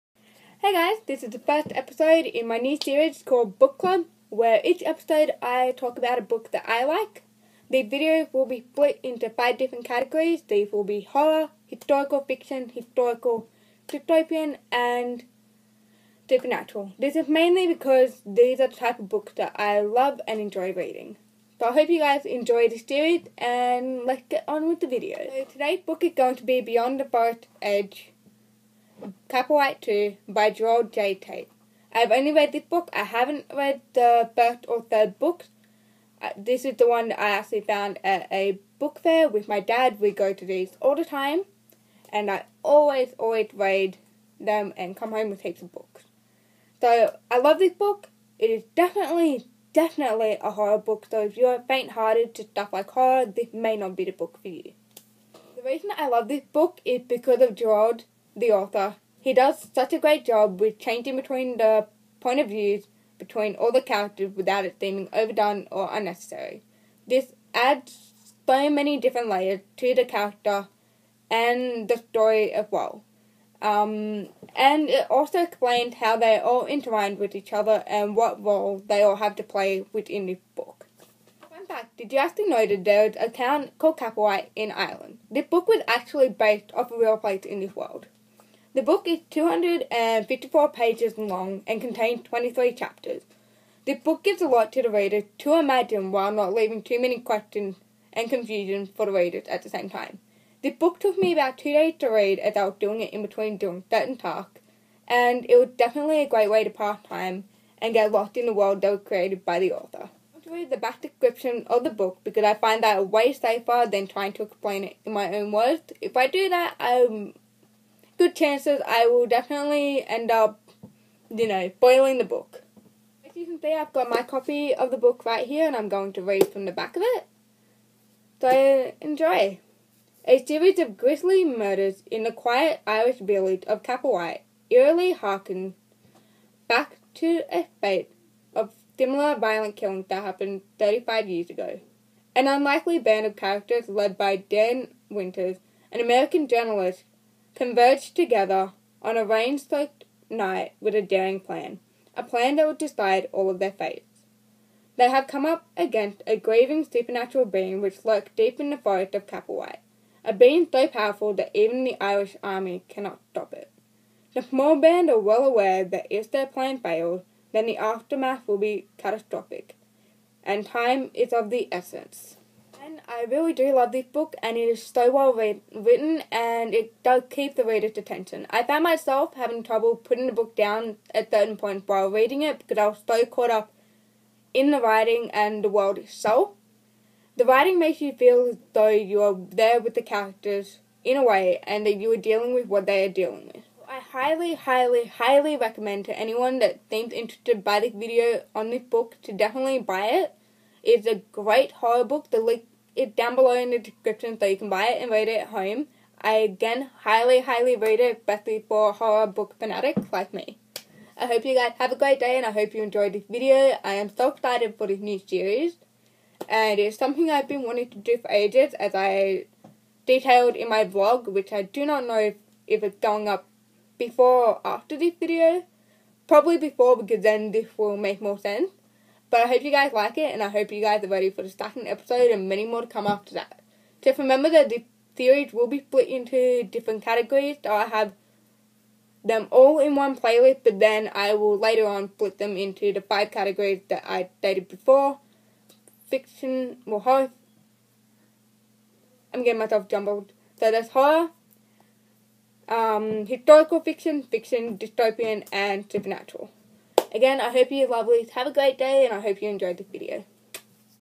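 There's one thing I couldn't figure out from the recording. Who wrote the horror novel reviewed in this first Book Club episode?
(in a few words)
Gerald J. Tate.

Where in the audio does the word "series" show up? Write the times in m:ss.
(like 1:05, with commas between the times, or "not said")
0:02, 0:22, 2:10, 3:35, 3:55.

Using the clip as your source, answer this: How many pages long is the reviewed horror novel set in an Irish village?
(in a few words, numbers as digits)
254.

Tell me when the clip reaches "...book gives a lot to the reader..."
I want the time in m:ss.
1:33.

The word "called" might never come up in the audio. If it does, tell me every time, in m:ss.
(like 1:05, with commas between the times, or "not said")
0:03, 1:23.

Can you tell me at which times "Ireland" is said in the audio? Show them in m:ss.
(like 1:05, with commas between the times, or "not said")
1:24.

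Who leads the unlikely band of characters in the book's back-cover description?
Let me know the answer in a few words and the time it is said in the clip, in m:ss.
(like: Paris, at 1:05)
Dan Winters, at 2:24.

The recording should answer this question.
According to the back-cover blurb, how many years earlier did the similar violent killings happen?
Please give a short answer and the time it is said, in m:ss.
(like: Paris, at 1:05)
35, at 2:20.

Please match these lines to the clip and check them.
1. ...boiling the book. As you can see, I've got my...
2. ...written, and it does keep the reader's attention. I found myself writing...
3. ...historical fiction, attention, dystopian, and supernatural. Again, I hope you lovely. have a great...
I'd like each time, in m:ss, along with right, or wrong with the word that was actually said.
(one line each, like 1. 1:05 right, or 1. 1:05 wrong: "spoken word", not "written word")
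1. 2:01 right
2. 2:55 wrong: "having", not "writing"
3. 4:13 wrong: "fiction", not "attention".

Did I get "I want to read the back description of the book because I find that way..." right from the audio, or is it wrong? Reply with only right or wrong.
right.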